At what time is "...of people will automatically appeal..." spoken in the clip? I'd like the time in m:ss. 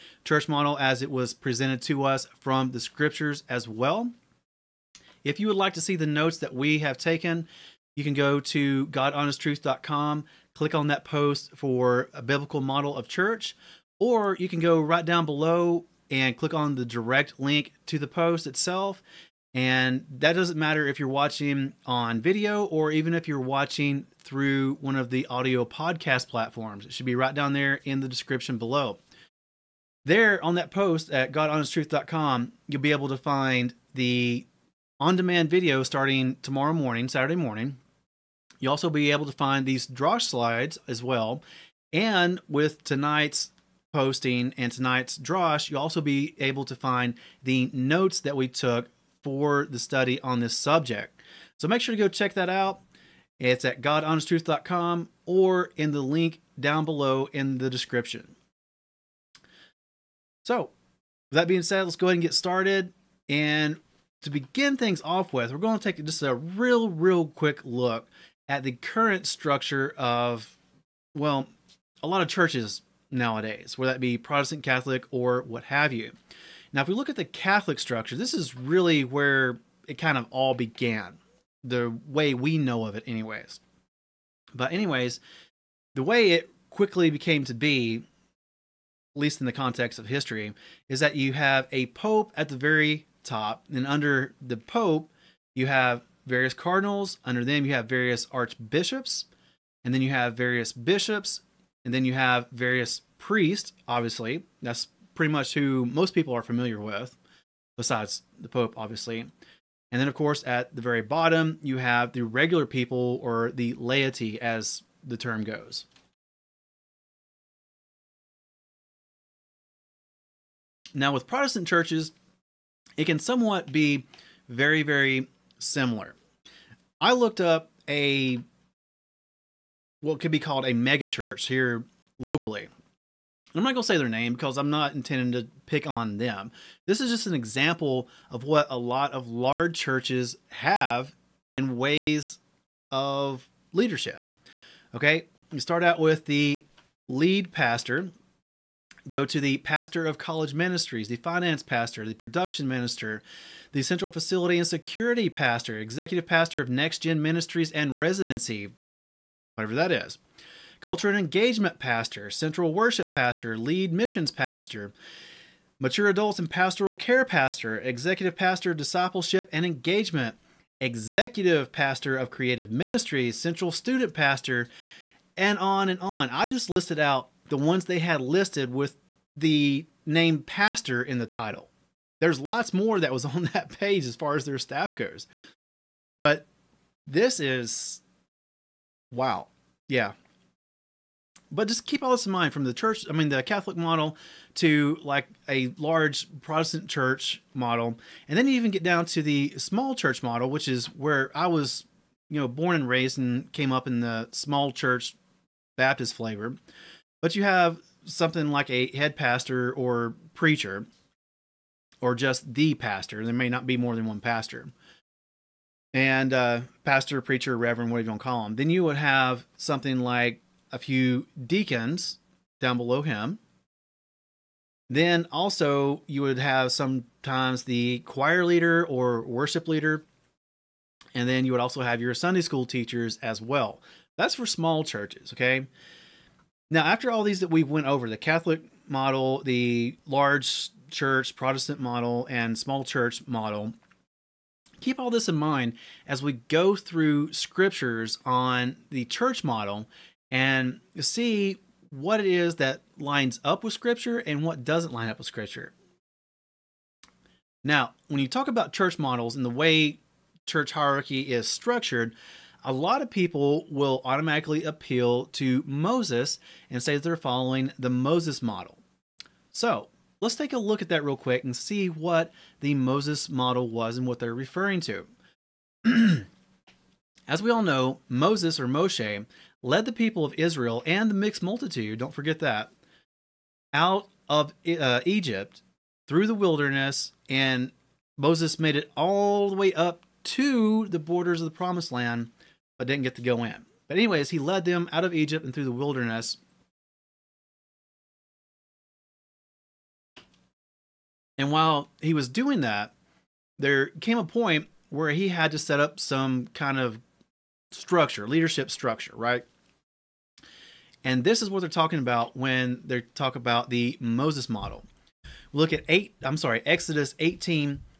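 4:23.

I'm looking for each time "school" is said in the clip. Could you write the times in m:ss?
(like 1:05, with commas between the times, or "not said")
3:52.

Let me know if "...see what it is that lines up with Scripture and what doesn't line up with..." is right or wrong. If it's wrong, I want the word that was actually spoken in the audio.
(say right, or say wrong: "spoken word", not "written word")
right.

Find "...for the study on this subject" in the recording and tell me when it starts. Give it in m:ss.
0:49.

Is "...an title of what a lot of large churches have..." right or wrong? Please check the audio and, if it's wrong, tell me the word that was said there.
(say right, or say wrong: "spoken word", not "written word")
wrong: "example", not "title".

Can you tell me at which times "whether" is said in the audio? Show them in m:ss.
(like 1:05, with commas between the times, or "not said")
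1:13.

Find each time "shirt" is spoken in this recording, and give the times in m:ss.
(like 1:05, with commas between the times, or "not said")
not said.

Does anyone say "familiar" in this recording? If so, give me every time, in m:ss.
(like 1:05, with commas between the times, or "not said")
1:46.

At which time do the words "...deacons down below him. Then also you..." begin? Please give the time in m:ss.
3:41.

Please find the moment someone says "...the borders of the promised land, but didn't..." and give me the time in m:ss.
4:50.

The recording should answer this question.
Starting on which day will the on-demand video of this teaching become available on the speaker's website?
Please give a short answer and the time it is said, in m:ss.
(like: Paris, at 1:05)
Saturday, at 0:37.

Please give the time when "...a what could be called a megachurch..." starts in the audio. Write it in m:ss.
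2:07.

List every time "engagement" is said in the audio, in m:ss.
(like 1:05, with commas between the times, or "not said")
2:41, 2:49.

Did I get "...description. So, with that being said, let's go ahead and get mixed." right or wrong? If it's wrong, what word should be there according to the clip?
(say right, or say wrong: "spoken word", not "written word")
wrong: "started", not "mixed".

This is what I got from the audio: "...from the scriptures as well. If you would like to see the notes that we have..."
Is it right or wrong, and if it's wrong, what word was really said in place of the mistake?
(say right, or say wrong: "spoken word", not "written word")
right.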